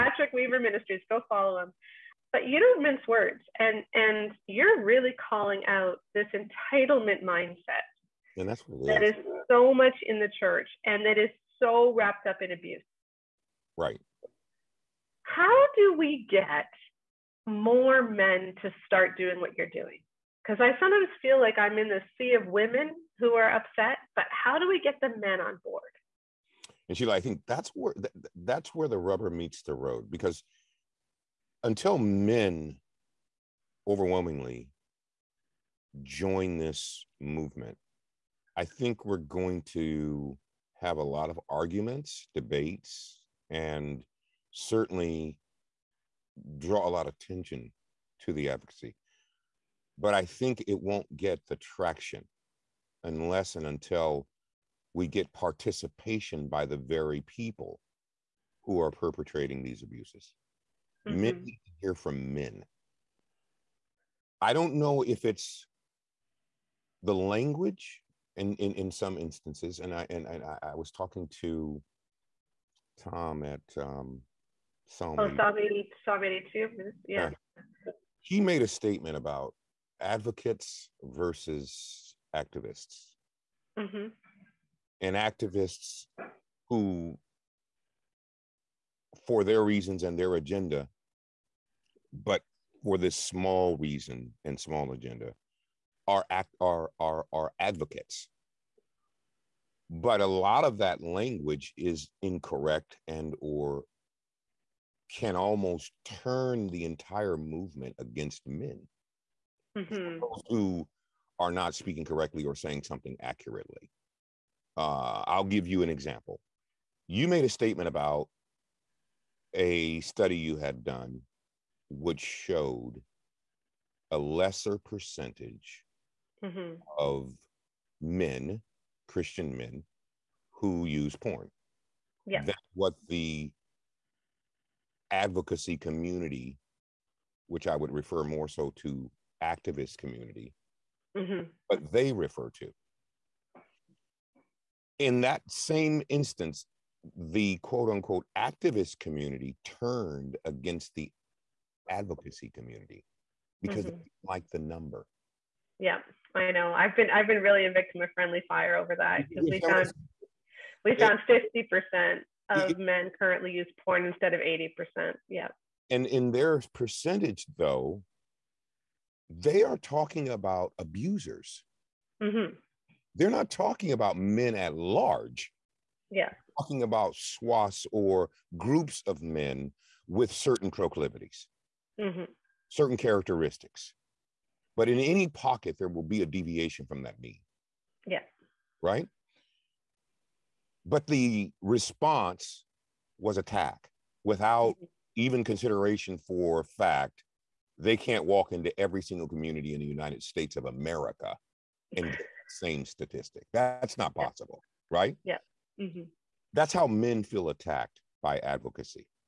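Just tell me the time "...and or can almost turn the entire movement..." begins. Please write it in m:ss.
1:43.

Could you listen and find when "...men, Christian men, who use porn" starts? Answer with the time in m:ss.
2:07.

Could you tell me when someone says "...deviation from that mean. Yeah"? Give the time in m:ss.
3:06.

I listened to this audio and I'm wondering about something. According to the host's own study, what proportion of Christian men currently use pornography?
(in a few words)
50%.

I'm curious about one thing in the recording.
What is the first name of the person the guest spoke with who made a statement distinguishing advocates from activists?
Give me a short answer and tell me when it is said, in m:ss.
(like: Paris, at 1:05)
Tom, at 1:12.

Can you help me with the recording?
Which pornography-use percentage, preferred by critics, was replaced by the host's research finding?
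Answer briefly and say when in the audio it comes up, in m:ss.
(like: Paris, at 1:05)
80%, at 2:44.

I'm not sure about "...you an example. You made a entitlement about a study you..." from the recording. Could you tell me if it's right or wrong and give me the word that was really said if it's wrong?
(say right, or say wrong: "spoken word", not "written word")
wrong: "statement", not "entitlement".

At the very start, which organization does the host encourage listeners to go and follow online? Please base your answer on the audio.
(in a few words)
Weaver Ministries.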